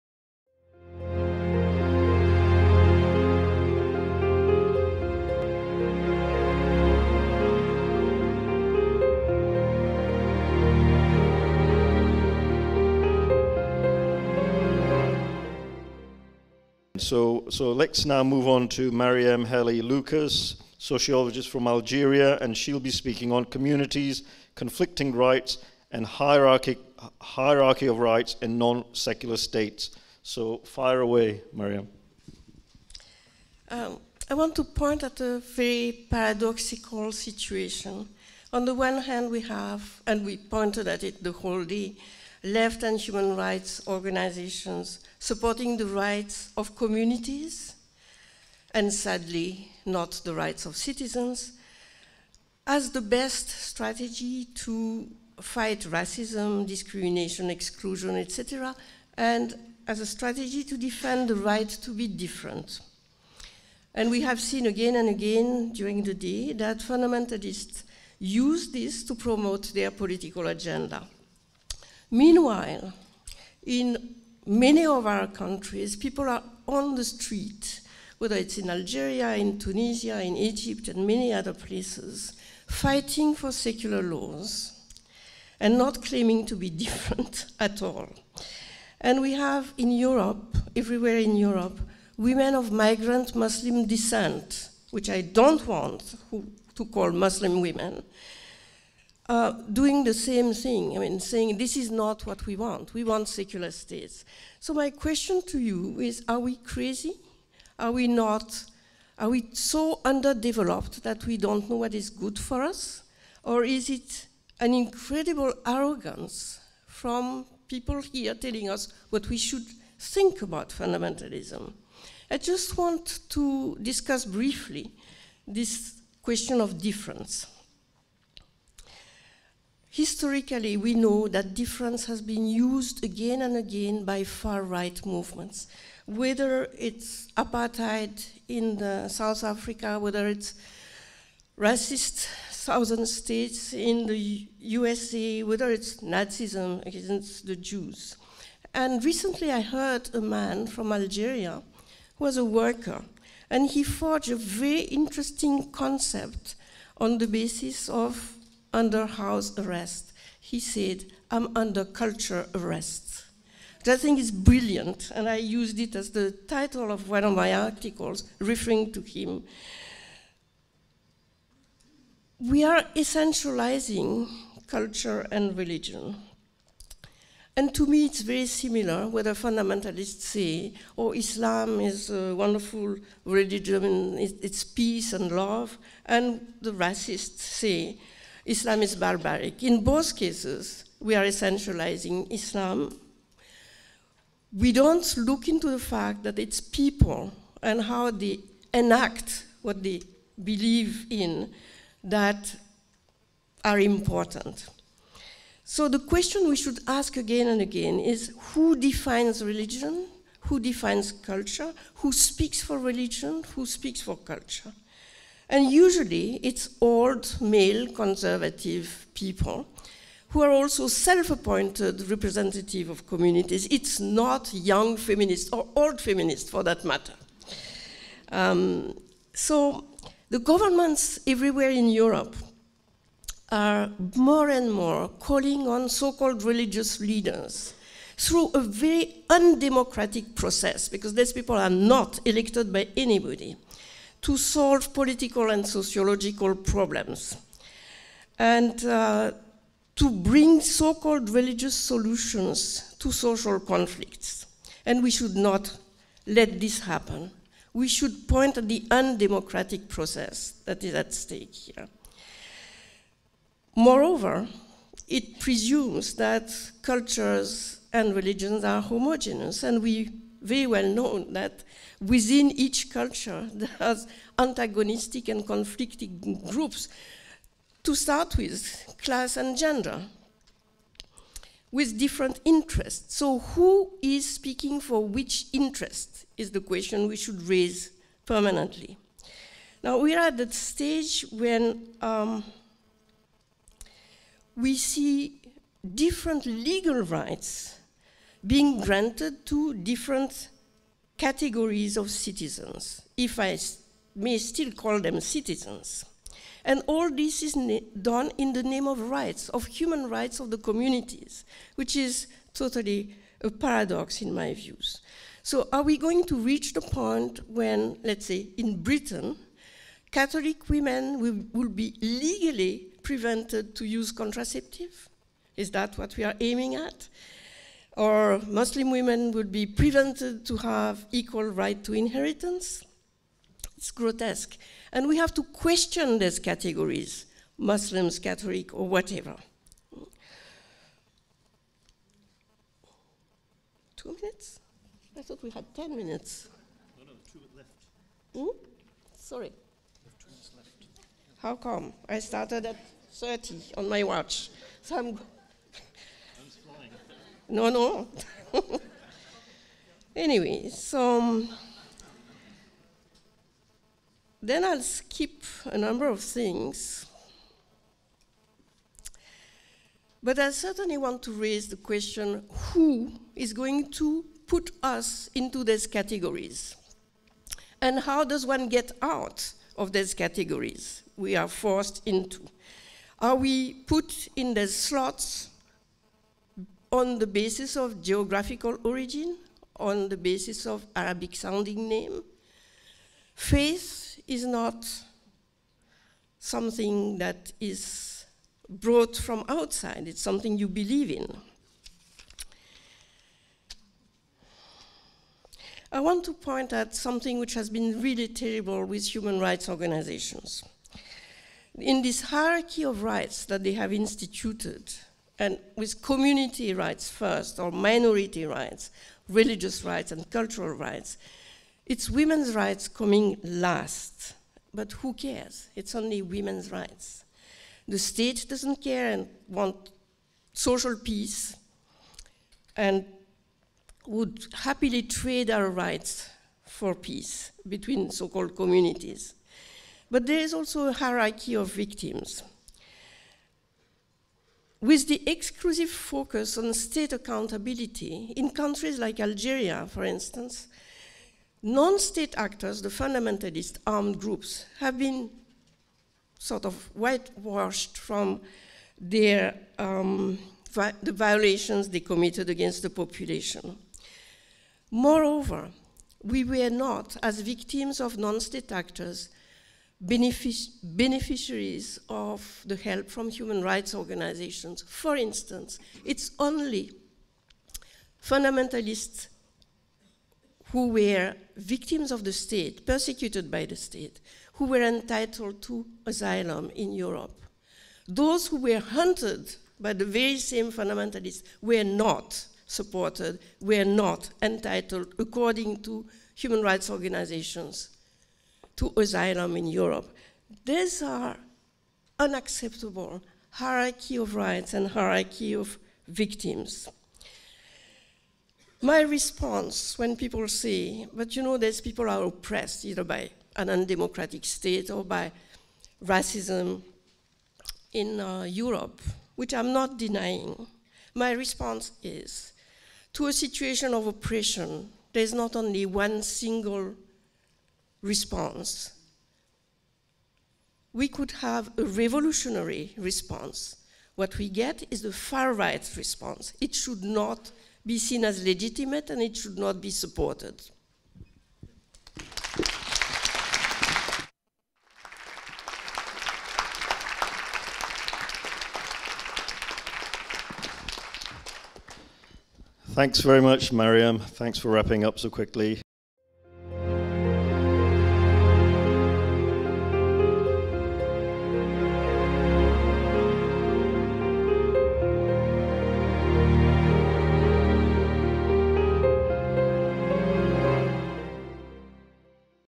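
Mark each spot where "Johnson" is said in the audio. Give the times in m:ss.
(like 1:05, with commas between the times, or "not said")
not said.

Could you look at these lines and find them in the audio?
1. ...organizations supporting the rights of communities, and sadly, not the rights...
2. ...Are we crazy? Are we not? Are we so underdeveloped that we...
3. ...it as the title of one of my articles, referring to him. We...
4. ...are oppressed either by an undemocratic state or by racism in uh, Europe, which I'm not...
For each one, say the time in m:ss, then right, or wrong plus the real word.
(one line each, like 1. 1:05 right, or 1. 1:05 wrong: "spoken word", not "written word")
1. 0:43 right
2. 1:46 right
3. 2:45 right
4. 8:32 right.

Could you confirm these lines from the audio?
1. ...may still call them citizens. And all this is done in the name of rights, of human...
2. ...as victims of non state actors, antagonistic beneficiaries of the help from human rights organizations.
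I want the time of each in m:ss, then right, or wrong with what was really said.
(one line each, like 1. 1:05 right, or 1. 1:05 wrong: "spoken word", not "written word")
1. 5:04 right
2. 7:47 wrong: "benefic", not "antagonistic".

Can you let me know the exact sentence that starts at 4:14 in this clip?
And we should not let this happen.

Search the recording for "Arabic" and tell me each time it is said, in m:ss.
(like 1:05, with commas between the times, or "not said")
6:30.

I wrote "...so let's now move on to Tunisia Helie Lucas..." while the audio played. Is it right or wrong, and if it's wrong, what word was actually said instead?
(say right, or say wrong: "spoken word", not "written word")
wrong: "Marieme", not "Tunisia".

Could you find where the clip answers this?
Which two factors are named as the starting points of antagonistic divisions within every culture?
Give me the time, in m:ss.
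4:39.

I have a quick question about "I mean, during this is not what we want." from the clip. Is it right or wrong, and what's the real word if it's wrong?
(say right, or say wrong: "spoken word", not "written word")
wrong: "saying", not "during".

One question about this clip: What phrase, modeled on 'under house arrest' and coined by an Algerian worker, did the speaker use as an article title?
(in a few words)
under culture arrest.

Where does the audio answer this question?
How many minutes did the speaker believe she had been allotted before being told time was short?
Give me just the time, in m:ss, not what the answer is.
5:45.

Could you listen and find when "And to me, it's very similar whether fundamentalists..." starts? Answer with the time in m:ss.
2:57.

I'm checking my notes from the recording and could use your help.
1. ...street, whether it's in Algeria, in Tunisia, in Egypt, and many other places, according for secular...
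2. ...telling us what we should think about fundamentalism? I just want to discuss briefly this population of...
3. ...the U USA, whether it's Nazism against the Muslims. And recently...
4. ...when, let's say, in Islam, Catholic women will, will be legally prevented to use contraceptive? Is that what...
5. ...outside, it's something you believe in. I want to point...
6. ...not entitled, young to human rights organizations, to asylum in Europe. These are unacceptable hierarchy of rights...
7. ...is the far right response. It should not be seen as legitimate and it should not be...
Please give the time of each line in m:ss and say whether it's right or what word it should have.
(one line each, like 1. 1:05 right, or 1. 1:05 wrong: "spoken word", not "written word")
1. 1:17 wrong: "fighting", not "according"
2. 1:58 wrong: "question", not "population"
3. 2:24 wrong: "Jews", not "Muslims"
4. 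5:17 wrong: "Britain", not "Islam"
5. 6:39 right
6. 8:13 wrong: "according", not "young"
7. 8:54 right.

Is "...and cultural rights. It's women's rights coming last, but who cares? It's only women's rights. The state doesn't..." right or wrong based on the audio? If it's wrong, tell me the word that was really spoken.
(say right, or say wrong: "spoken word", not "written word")
right.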